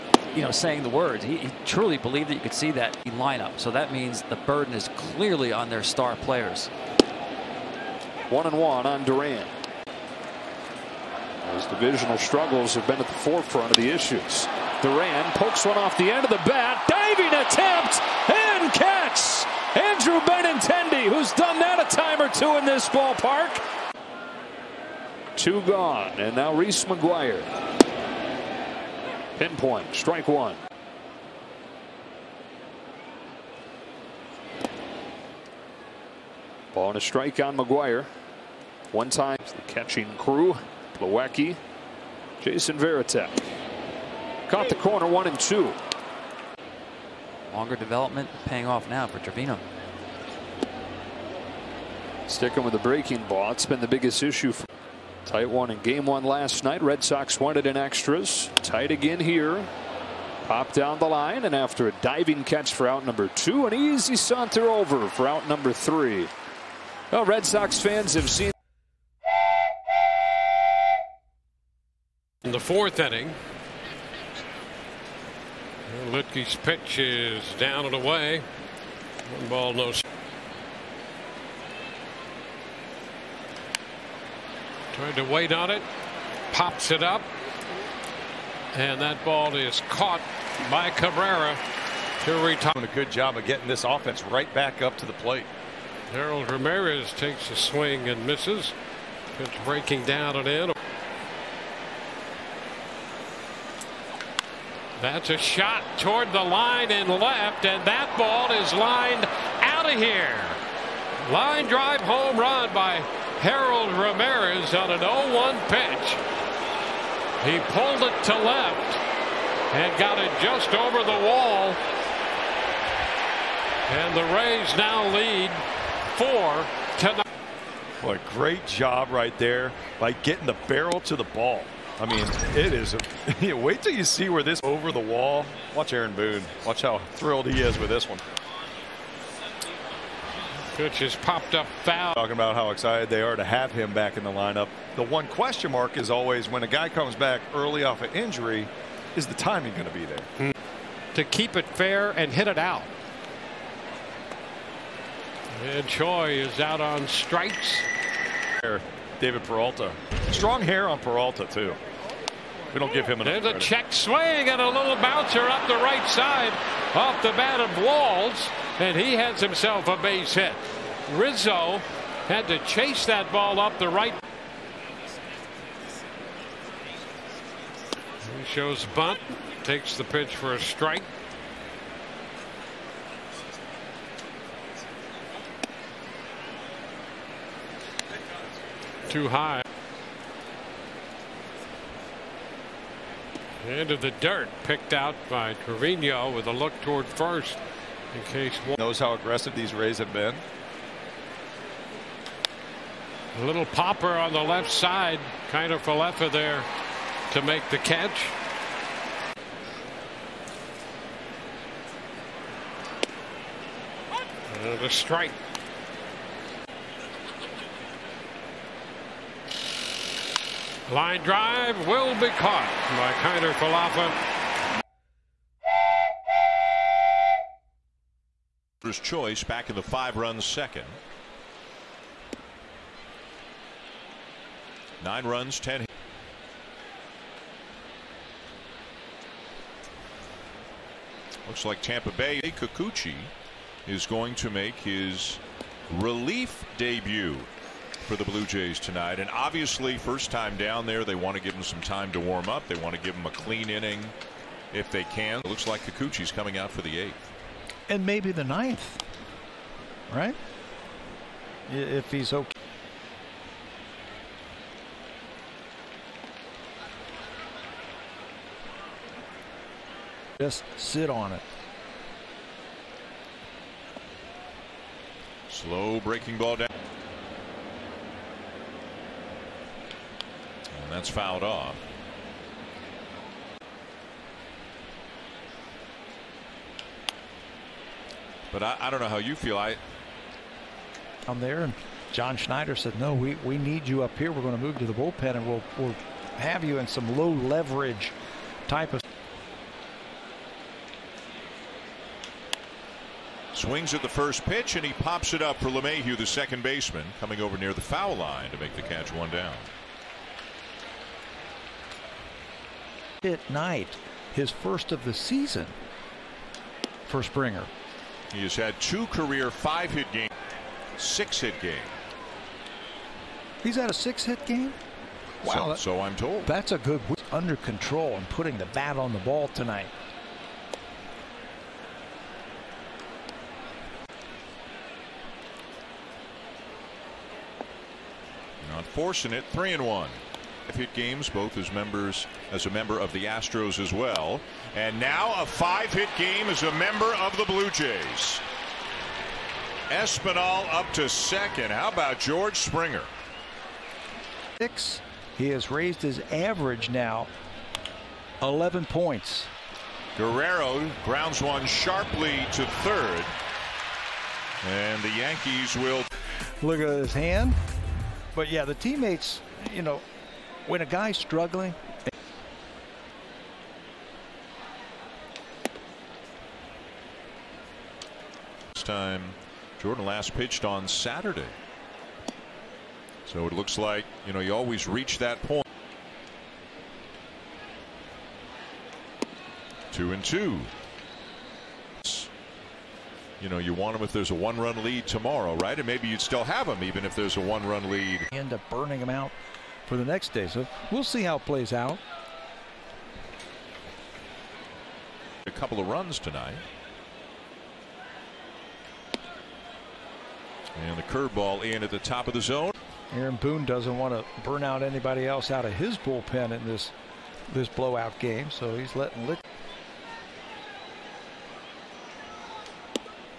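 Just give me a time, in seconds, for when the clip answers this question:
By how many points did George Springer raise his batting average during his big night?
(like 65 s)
358 s.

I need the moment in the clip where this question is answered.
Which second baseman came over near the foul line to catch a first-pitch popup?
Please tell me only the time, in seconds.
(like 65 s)
305 s.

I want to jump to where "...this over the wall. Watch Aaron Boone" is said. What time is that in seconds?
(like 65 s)
134 s.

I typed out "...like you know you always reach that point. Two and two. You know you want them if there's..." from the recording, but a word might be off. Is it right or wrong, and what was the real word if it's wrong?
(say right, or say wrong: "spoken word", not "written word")
right.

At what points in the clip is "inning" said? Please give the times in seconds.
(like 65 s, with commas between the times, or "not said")
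72 s, 253 s.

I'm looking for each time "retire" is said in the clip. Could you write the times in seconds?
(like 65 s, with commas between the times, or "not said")
92 s.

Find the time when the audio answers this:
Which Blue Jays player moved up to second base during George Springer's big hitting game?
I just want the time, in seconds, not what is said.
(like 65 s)
349 s.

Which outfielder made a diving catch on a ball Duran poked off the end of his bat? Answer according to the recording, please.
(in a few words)
Andrew Benintendi.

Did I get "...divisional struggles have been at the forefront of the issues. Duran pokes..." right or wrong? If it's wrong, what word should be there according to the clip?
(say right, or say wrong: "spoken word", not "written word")
right.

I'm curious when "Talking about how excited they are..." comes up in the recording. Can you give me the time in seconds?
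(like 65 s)
142 s.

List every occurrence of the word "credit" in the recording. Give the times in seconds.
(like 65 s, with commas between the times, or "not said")
163 s.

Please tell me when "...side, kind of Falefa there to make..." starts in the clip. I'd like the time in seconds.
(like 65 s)
204 s.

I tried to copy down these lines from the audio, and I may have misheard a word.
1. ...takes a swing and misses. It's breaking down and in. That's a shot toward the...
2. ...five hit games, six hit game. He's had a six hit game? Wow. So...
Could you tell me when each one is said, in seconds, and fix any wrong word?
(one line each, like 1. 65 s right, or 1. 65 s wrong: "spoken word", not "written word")
1. 97 s right
2. 319 s right.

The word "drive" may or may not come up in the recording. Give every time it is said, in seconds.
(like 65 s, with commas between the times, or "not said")
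111 s, 221 s.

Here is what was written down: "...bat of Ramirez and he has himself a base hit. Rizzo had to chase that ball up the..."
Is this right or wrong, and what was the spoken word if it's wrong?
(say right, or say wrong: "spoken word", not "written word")
wrong: "Walls", not "Ramirez".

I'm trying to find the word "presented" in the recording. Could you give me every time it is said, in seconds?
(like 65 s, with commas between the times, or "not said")
not said.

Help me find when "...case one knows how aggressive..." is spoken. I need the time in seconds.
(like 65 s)
198 s.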